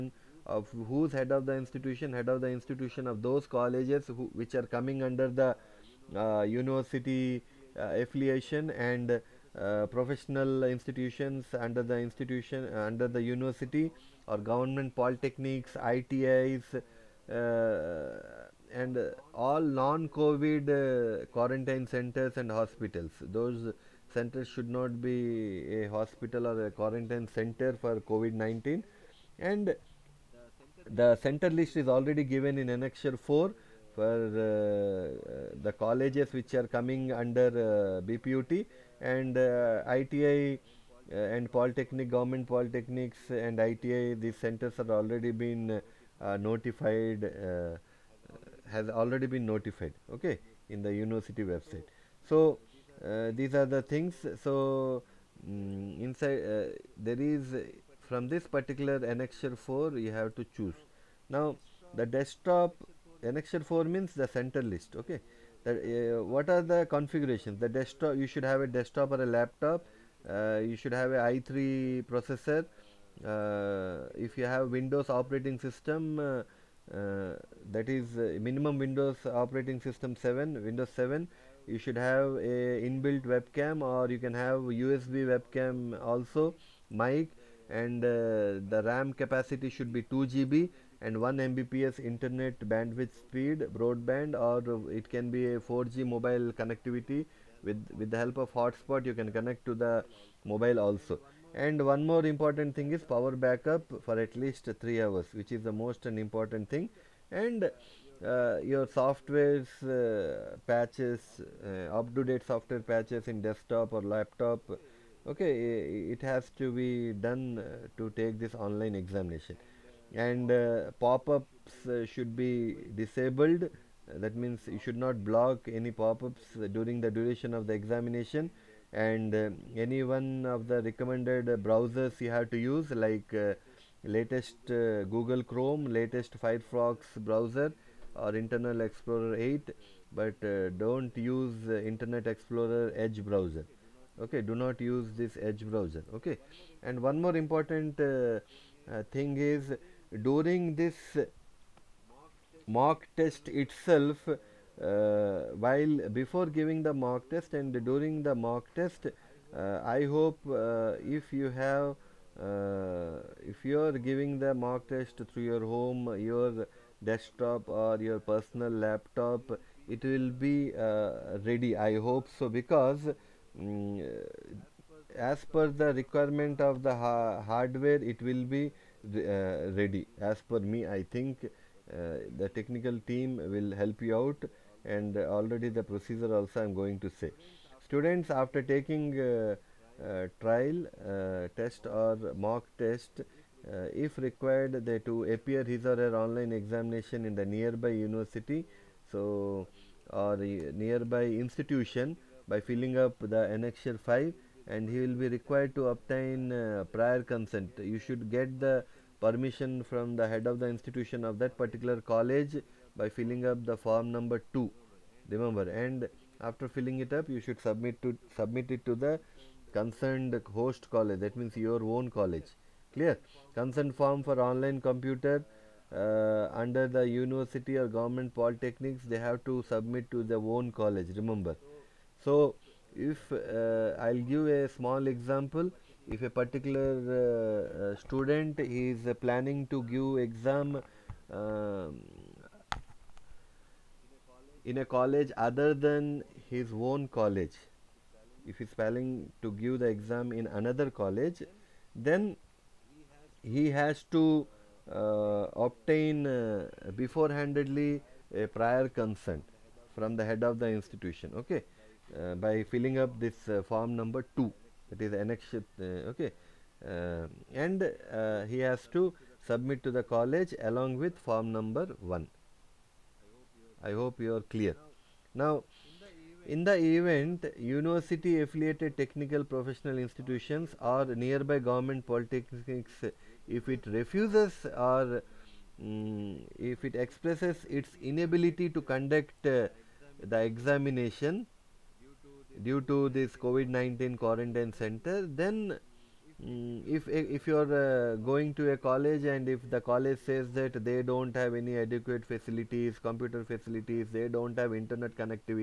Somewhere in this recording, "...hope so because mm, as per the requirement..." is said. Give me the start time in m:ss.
2:51.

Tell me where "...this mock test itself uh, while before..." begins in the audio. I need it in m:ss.
2:30.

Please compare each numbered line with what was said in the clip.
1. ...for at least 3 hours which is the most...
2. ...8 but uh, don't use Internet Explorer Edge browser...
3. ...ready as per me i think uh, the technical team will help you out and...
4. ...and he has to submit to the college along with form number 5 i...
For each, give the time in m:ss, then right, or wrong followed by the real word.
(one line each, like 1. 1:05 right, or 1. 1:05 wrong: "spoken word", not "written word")
1. 1:44 right
2. 2:19 right
3. 2:59 right
4. 4:27 wrong: "1", not "5".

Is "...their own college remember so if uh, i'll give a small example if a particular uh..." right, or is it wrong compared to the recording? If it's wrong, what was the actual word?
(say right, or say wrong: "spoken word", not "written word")
right.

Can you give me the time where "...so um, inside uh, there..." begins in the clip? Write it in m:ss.
0:54.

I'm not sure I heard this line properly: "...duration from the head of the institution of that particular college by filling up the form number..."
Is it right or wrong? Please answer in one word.
wrong.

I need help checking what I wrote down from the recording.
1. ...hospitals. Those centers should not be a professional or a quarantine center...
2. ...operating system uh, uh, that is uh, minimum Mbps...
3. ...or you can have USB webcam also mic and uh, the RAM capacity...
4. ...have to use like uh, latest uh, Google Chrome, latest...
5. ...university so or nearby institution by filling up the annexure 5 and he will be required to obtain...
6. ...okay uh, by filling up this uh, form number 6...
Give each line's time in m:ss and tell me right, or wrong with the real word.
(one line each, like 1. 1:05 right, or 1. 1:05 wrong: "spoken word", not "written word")
1. 0:22 wrong: "hospital", not "professional"
2. 1:15 wrong: "Windows", not "Mbps"
3. 1:23 right
4. 2:12 right
5. 3:17 right
6. 4:21 wrong: "2", not "6".